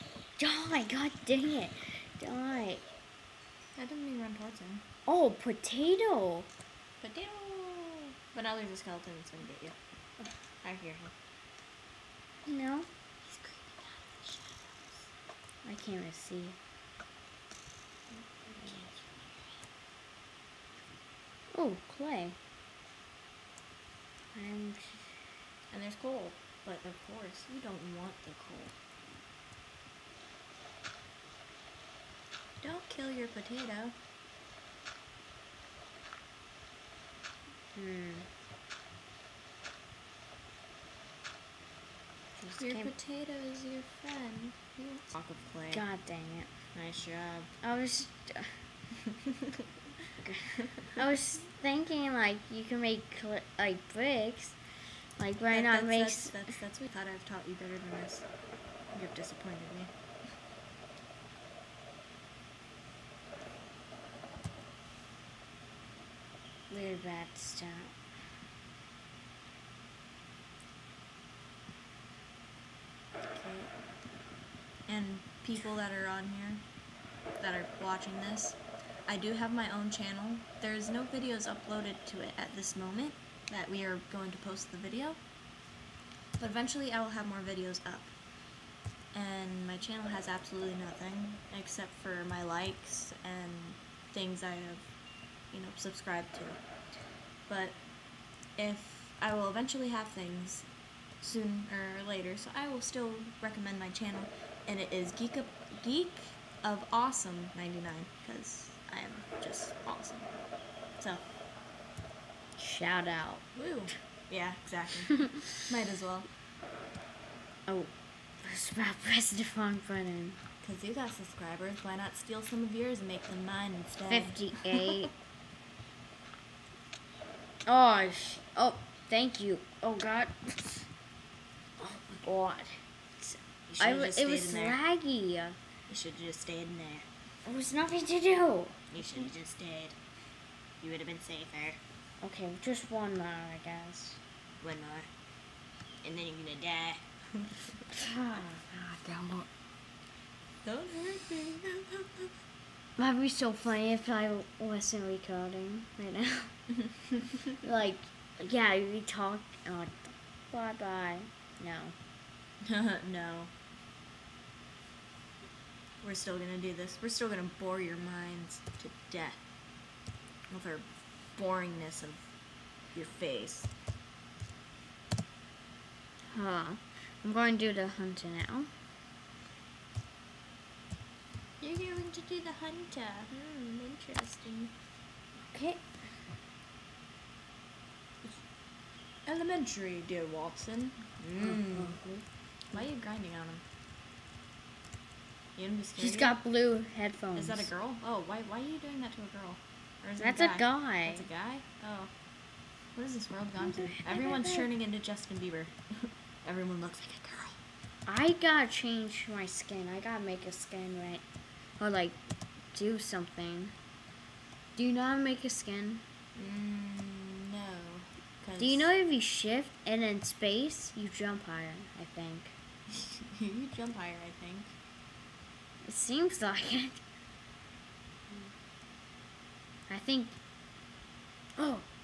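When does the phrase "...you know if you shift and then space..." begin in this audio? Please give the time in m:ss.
3:38.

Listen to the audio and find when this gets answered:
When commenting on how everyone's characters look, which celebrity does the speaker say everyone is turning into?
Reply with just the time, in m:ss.
3:24.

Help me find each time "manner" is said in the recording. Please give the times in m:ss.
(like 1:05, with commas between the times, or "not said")
not said.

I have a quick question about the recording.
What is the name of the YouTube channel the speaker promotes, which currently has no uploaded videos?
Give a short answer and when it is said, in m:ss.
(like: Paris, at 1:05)
Geek of Awesome 99, at 1:45.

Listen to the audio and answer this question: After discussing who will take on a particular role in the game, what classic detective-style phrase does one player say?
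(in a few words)
Elementary, dear Watson.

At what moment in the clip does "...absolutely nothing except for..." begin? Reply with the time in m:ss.
1:30.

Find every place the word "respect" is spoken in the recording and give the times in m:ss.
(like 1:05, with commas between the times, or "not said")
not said.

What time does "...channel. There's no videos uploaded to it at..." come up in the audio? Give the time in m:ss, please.
1:19.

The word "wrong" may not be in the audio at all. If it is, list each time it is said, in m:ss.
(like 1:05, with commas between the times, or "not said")
1:59.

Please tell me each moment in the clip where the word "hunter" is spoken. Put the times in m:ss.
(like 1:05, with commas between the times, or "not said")
2:57, 3:02.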